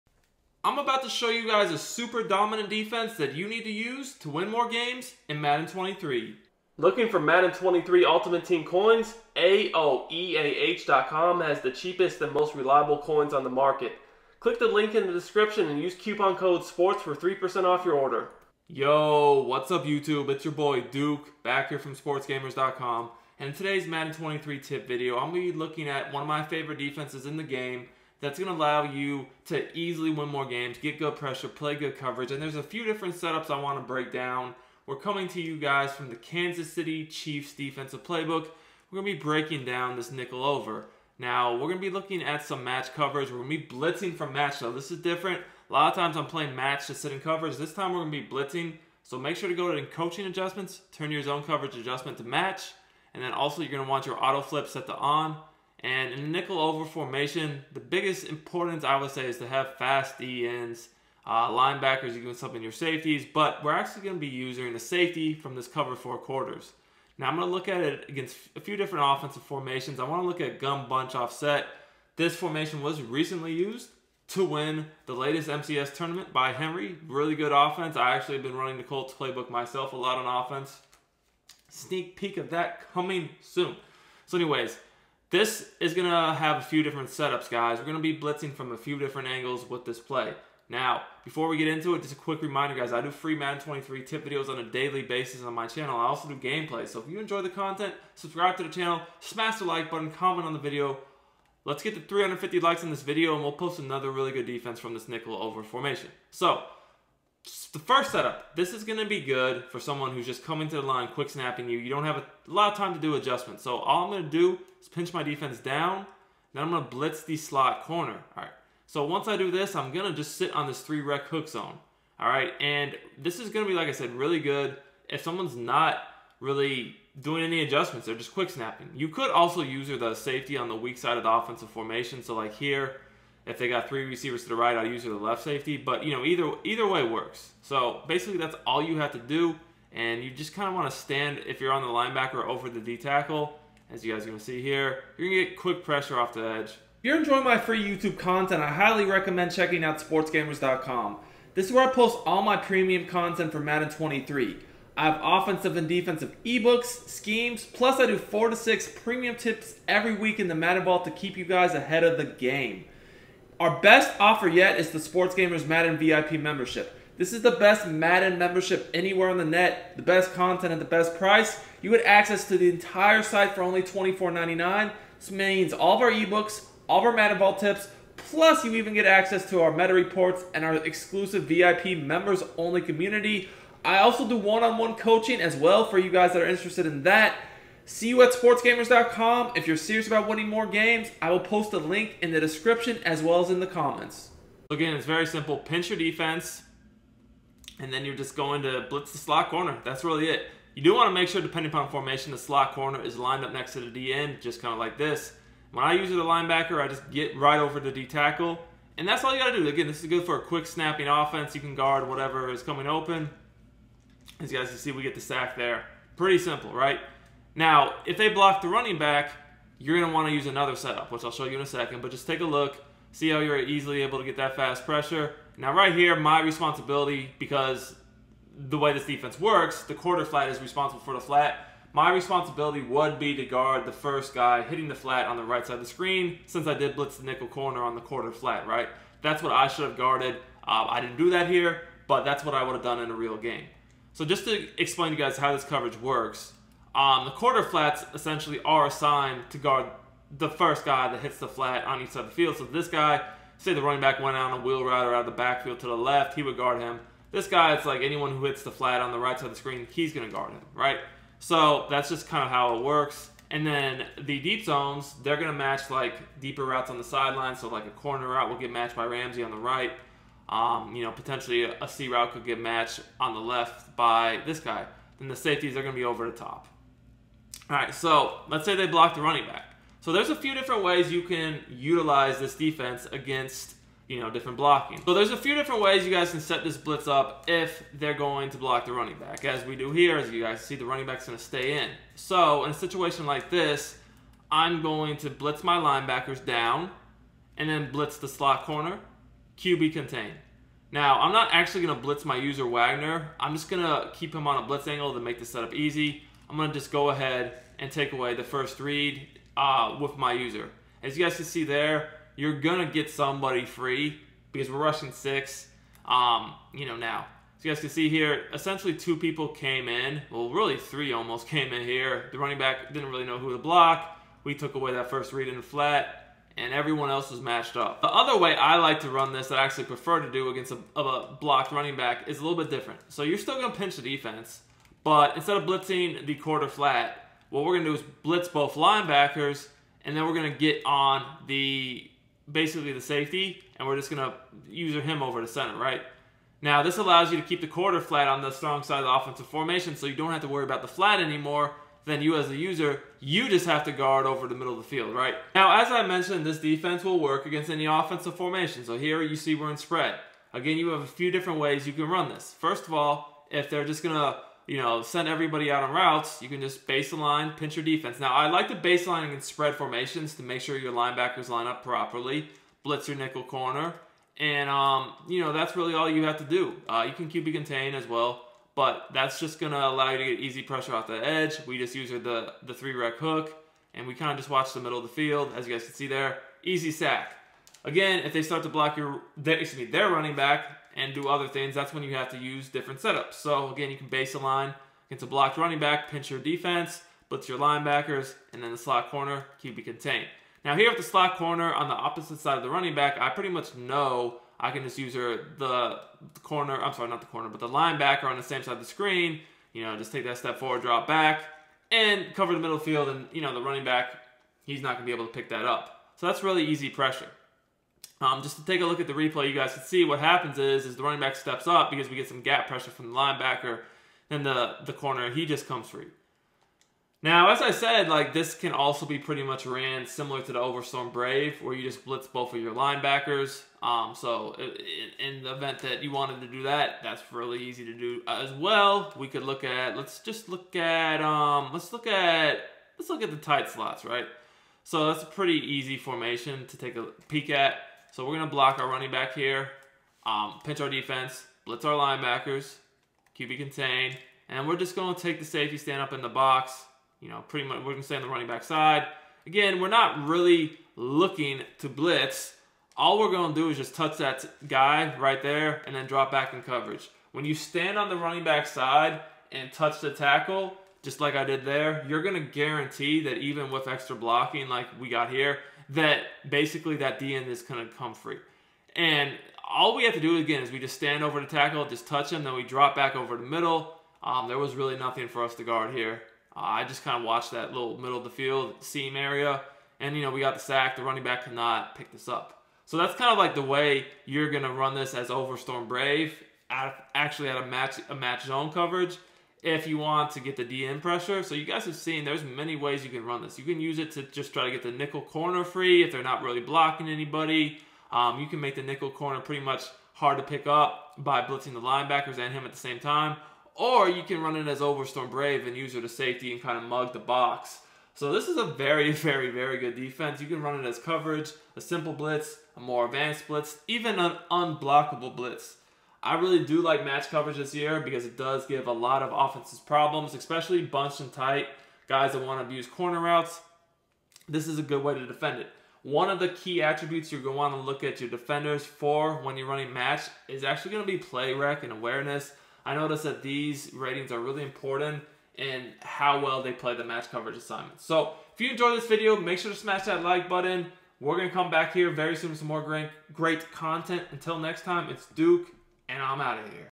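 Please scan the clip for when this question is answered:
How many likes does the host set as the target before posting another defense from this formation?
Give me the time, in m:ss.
1:42.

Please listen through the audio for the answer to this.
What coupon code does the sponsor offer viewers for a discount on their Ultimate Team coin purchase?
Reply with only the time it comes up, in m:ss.
0:16.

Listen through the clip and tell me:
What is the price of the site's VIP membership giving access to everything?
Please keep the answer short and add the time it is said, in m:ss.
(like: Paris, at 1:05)
$24.99, at 2:53.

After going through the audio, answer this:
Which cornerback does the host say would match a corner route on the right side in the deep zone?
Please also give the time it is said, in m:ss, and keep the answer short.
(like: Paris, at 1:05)
Ramsey, at 4:29.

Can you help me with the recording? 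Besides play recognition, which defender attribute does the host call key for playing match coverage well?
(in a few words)
awareness.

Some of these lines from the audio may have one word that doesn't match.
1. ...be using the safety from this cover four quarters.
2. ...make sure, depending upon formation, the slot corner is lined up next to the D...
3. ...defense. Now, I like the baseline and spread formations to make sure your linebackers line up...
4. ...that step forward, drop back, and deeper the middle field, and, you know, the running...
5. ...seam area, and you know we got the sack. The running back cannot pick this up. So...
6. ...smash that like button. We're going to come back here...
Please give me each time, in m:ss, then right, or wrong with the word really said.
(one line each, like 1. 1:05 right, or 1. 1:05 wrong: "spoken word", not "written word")
1. 1:04 right
2. 3:21 right
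3. 6:07 right
4. 6:50 wrong: "cover", not "deeper"
5. 8:08 right
6. 9:09 right.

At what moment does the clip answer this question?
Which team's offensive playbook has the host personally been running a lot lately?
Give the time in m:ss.
1:18.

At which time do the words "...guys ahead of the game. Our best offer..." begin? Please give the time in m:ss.
2:41.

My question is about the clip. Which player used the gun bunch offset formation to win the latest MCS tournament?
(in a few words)
Henry.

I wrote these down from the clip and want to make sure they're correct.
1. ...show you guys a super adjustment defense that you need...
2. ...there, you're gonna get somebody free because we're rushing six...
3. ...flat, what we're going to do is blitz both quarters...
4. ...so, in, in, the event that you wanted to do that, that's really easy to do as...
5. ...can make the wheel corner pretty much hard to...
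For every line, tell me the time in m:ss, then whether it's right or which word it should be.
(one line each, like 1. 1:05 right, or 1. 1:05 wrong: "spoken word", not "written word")
1. 0:01 wrong: "dominant", not "adjustment"
2. 5:11 right
3. 5:36 wrong: "linebackers", not "quarters"
4. 7:14 right
5. 8:28 wrong: "nickel", not "wheel".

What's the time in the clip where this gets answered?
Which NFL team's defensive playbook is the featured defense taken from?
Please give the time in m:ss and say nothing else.
0:36.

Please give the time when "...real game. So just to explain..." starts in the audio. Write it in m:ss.
4:03.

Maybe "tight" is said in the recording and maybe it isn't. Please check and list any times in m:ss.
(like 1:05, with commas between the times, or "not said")
7:23, 8:51.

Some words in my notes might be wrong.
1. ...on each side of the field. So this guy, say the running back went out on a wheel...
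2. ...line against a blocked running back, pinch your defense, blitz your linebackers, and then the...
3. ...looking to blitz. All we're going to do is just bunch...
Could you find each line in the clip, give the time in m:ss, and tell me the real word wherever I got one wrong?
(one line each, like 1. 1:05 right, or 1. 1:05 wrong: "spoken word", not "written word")
1. 4:11 right
2. 6:34 right
3. 7:40 wrong: "touch", not "bunch".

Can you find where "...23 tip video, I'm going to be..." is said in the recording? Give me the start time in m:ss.
0:24.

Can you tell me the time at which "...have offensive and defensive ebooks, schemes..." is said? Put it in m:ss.
2:35.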